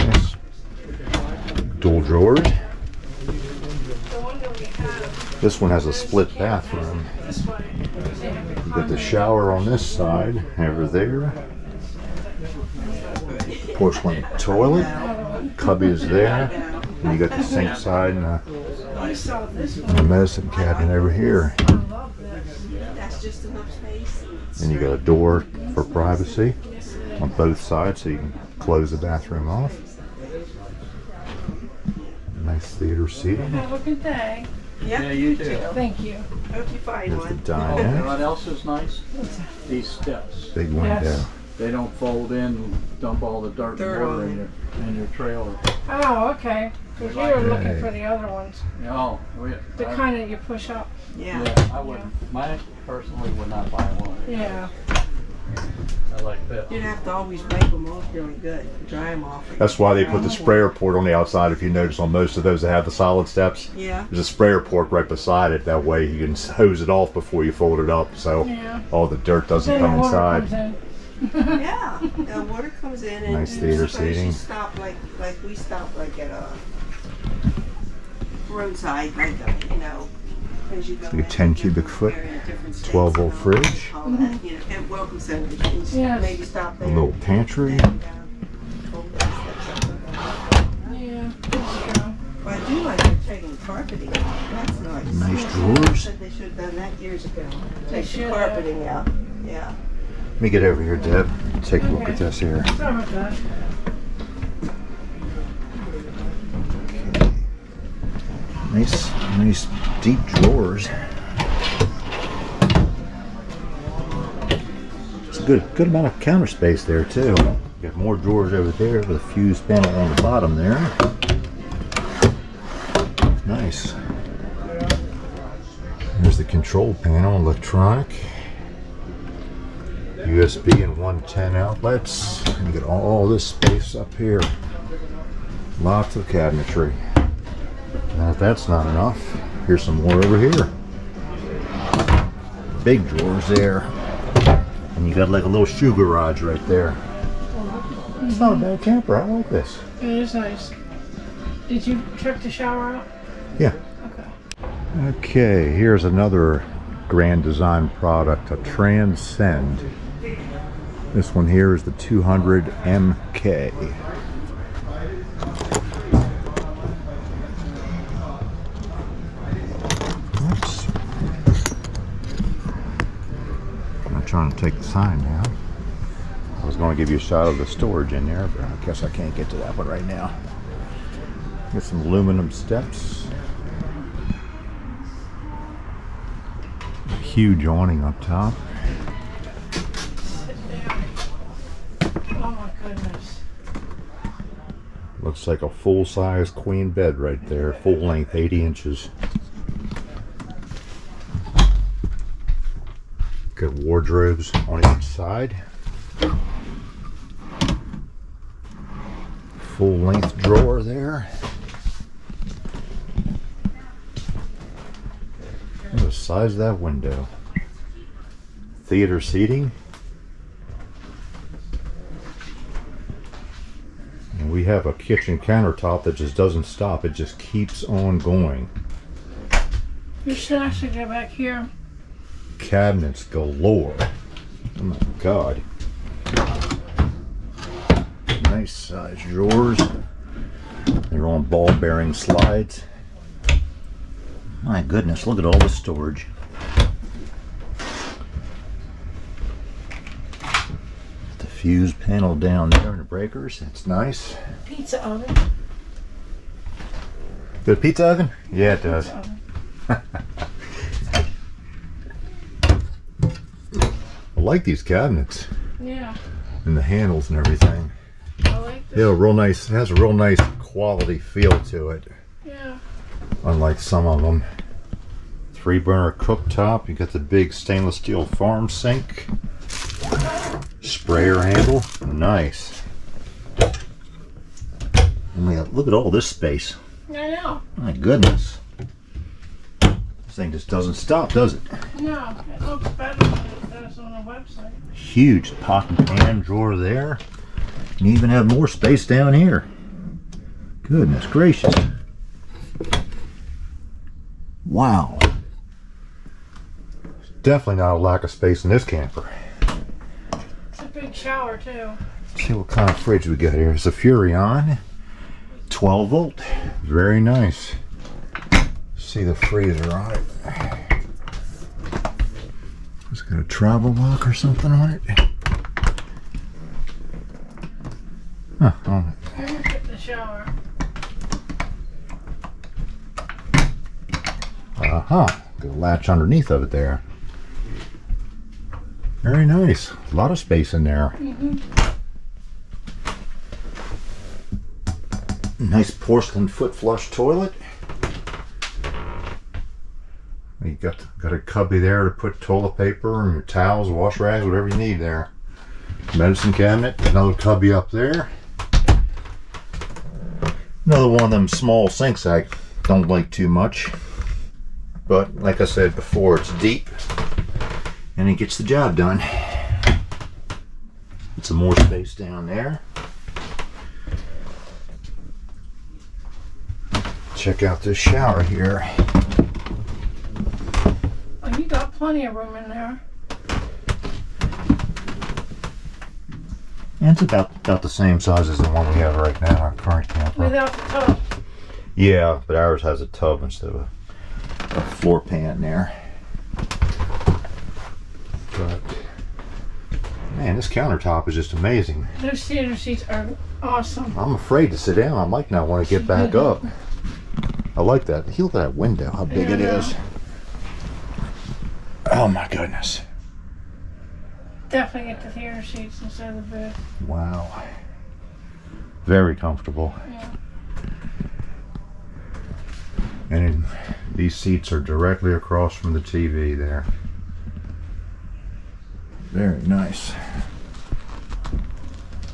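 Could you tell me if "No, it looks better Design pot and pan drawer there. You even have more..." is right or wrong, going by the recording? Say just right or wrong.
wrong.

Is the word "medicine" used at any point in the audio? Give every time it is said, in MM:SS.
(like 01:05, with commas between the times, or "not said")
00:20, 05:56.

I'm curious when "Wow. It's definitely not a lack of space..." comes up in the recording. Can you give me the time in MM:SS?
05:04.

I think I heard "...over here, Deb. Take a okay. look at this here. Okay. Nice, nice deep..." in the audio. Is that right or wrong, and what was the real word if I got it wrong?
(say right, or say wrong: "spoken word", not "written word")
right.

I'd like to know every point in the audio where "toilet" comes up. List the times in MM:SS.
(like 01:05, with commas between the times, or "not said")
00:14, 05:47, 05:52.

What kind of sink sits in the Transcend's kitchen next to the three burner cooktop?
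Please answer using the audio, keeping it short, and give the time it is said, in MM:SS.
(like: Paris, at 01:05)
stainless steel farm sink, at 04:37.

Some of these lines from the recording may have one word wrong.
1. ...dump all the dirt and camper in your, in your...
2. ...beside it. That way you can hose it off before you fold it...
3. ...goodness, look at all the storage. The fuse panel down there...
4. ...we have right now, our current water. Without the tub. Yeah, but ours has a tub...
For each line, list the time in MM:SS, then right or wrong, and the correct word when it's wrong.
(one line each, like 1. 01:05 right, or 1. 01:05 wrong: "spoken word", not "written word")
1. 00:43 wrong: "water", not "camper"
2. 01:05 right
3. 04:04 right
4. 06:28 wrong: "camper", not "water".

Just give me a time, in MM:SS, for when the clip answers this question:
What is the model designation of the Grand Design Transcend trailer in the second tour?
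02:41.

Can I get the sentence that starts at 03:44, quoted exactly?
And we have a kitchen countertop that just doesn't stop.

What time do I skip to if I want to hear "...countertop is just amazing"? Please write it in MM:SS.
06:40.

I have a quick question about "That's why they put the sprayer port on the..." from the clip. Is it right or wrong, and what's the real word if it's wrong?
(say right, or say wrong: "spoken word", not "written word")
right.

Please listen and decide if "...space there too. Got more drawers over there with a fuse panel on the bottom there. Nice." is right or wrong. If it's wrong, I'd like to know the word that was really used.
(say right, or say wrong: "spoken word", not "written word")
right.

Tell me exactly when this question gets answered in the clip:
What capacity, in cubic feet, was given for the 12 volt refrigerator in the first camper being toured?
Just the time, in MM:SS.
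01:21.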